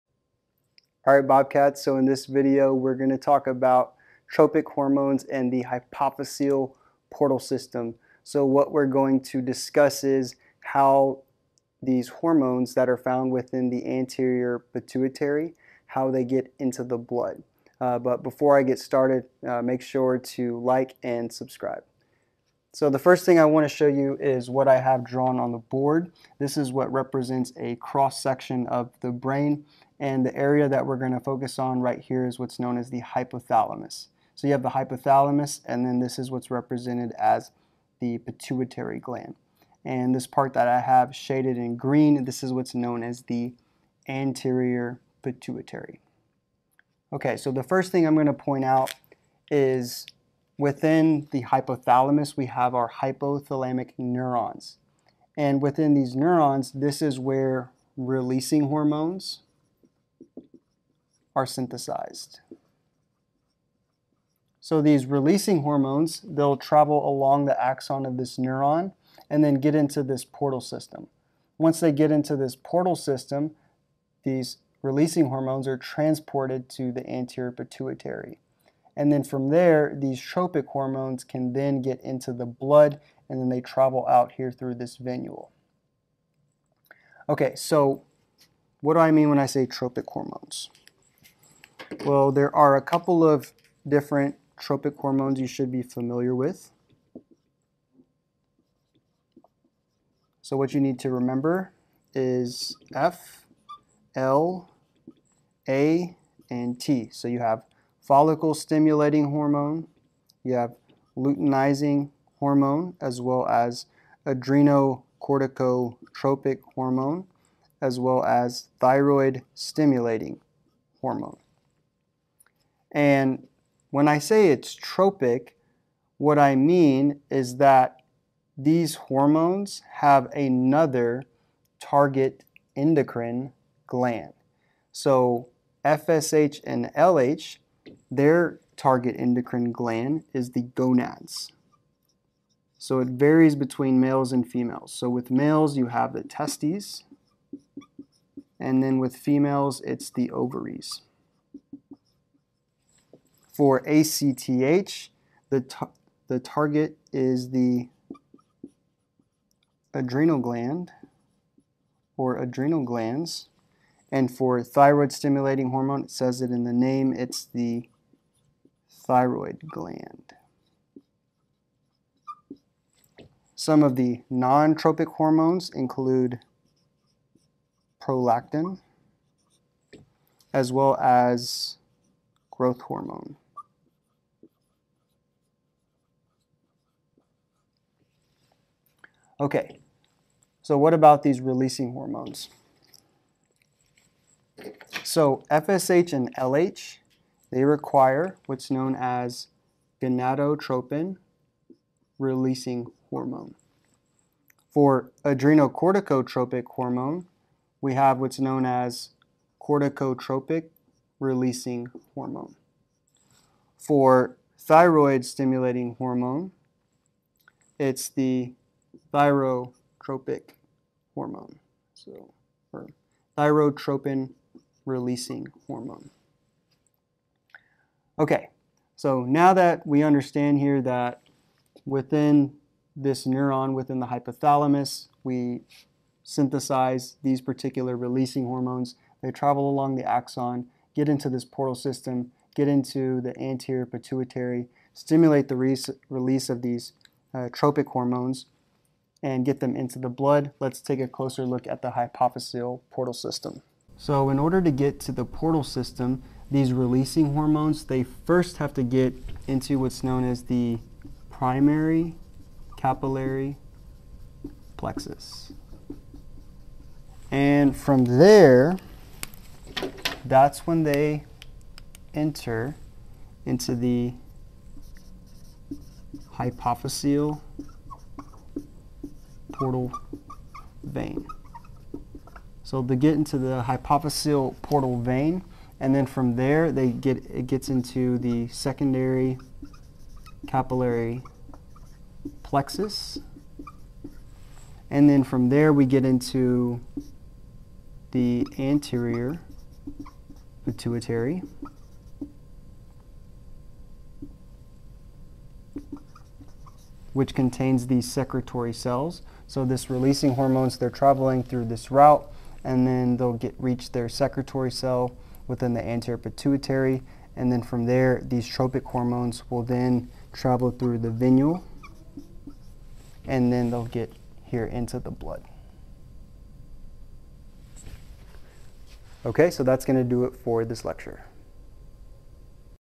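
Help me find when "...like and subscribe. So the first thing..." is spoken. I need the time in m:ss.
0:20.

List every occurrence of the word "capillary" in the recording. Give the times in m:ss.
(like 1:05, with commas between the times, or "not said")
4:22, 4:50.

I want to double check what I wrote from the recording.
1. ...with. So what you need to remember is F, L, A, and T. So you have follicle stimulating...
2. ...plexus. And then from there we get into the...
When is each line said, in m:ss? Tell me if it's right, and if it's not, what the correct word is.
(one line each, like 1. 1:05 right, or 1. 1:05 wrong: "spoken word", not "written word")
1. 1:36 right
2. 4:52 right.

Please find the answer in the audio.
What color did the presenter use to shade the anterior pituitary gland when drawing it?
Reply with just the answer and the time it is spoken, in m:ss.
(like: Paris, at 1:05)
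Green, at 0:41.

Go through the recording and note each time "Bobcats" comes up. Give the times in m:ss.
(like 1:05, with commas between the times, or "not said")
0:01.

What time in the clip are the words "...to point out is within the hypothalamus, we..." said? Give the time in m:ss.
0:48.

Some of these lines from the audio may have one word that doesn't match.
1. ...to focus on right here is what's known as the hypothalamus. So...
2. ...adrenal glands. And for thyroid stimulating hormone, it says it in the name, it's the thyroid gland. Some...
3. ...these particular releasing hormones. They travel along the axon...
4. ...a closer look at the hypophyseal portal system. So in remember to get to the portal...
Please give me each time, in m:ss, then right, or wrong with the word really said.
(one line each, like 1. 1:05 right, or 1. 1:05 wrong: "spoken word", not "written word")
1. 0:31 right
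2. 2:42 right
3. 3:57 right
4. 4:10 wrong: "order", not "remember".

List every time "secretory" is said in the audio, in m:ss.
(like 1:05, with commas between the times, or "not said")
5:08, 5:14.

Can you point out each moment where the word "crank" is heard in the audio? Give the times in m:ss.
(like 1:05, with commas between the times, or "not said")
not said.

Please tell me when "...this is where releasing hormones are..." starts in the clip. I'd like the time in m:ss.
0:56.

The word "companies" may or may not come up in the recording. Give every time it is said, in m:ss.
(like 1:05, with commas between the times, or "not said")
not said.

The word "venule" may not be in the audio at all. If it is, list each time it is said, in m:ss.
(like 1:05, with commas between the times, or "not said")
1:24, 5:21.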